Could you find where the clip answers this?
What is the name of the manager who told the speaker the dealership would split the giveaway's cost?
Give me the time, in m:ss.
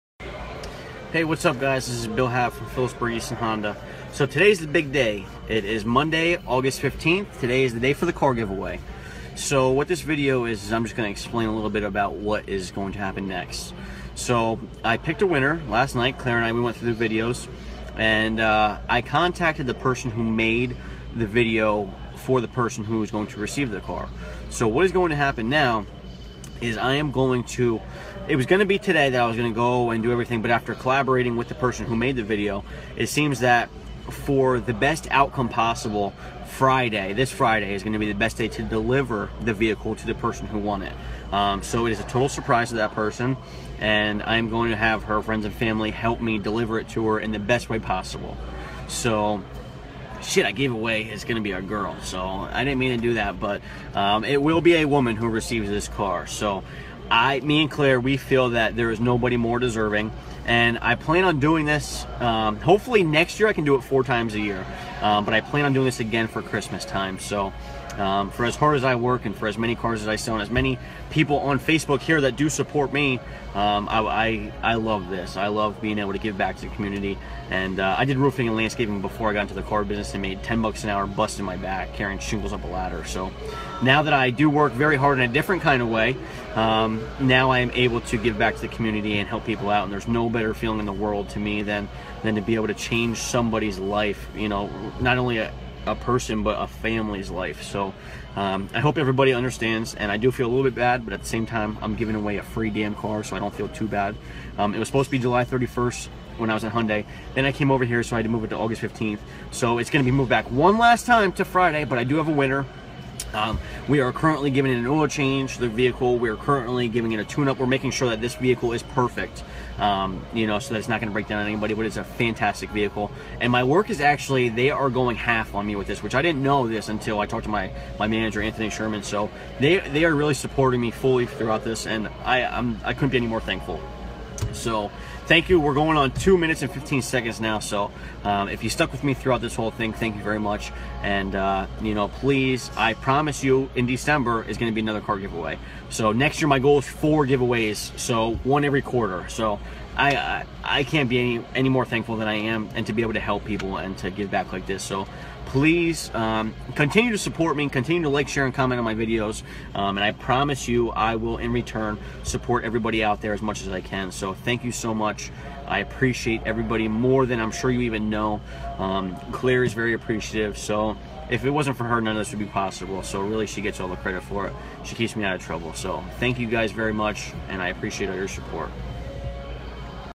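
2:08.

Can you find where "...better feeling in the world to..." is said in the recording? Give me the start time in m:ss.
1:30.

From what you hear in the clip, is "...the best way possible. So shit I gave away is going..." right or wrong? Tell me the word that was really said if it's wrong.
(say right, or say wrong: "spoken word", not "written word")
right.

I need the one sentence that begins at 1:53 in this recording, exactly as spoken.
Um, we are currently giving it an oil change, the vehicle.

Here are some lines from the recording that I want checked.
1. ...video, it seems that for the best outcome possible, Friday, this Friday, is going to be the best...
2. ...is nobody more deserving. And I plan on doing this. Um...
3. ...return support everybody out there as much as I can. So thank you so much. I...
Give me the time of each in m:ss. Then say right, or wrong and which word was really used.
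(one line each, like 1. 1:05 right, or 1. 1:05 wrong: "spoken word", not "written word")
1. 0:32 right
2. 0:58 right
3. 2:41 right.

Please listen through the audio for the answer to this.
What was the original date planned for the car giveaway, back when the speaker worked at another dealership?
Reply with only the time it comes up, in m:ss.
1:45.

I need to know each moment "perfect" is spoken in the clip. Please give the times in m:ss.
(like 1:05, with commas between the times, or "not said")
1:58.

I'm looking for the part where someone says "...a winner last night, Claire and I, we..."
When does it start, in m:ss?
0:15.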